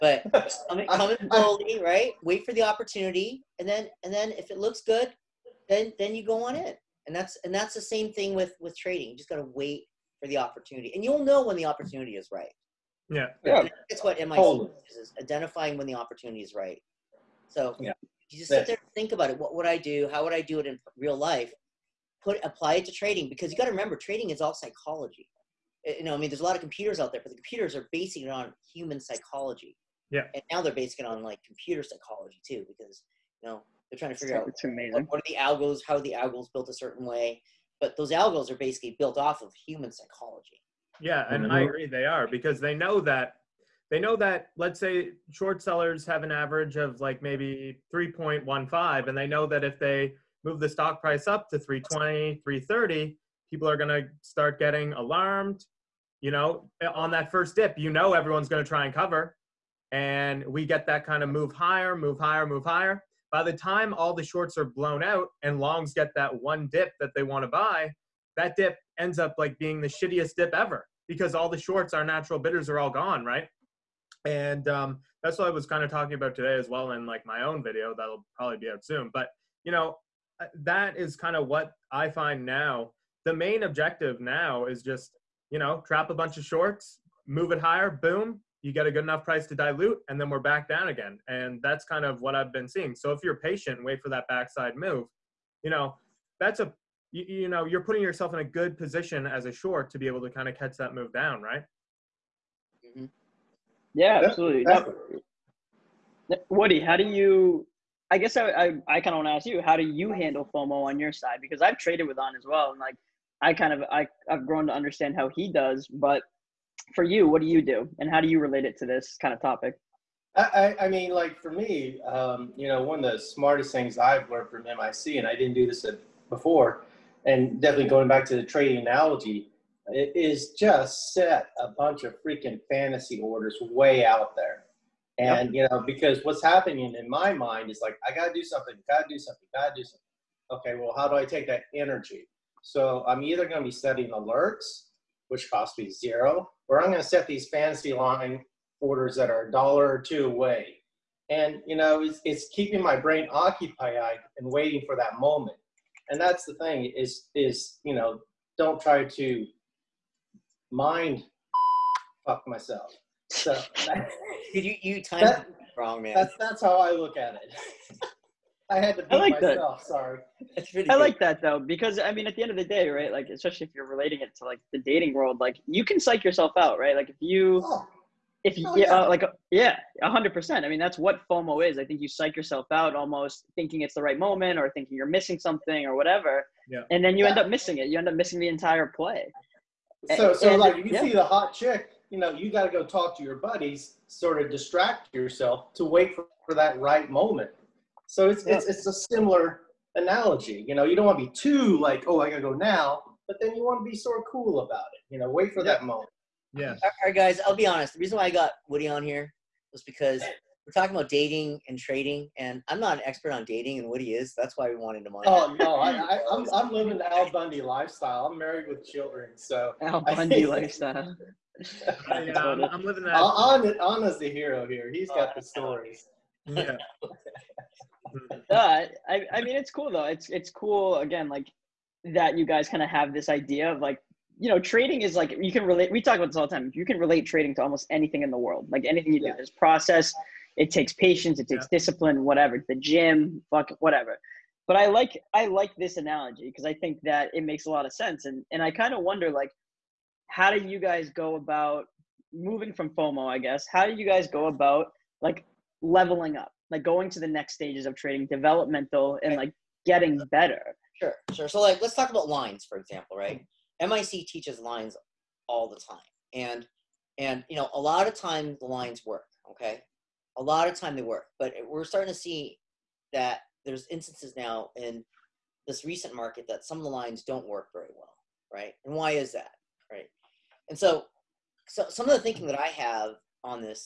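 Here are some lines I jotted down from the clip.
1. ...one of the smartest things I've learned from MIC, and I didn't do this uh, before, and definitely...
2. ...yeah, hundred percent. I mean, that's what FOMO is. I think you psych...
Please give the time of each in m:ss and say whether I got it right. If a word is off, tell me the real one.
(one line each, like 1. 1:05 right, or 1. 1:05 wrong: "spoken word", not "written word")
1. 2:02 right
2. 2:59 right.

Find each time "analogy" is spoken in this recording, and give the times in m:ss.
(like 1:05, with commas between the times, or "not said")
2:08, 3:19, 4:05.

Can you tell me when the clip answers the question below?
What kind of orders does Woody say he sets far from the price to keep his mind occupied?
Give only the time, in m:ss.
2:12.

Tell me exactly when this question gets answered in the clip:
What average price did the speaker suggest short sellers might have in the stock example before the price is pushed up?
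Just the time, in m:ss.
0:47.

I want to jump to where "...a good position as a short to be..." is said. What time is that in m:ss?
1:38.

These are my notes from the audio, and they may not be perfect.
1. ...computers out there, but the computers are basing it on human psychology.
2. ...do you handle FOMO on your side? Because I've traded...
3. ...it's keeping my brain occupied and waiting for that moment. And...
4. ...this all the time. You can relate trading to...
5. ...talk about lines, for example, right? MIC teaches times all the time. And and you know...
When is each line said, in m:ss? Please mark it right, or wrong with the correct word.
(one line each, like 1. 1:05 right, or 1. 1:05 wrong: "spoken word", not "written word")
1. 0:26 right
2. 1:49 right
3. 2:32 right
4. 3:56 right
5. 4:21 wrong: "lines", not "times".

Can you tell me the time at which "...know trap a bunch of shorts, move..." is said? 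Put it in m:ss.
1:25.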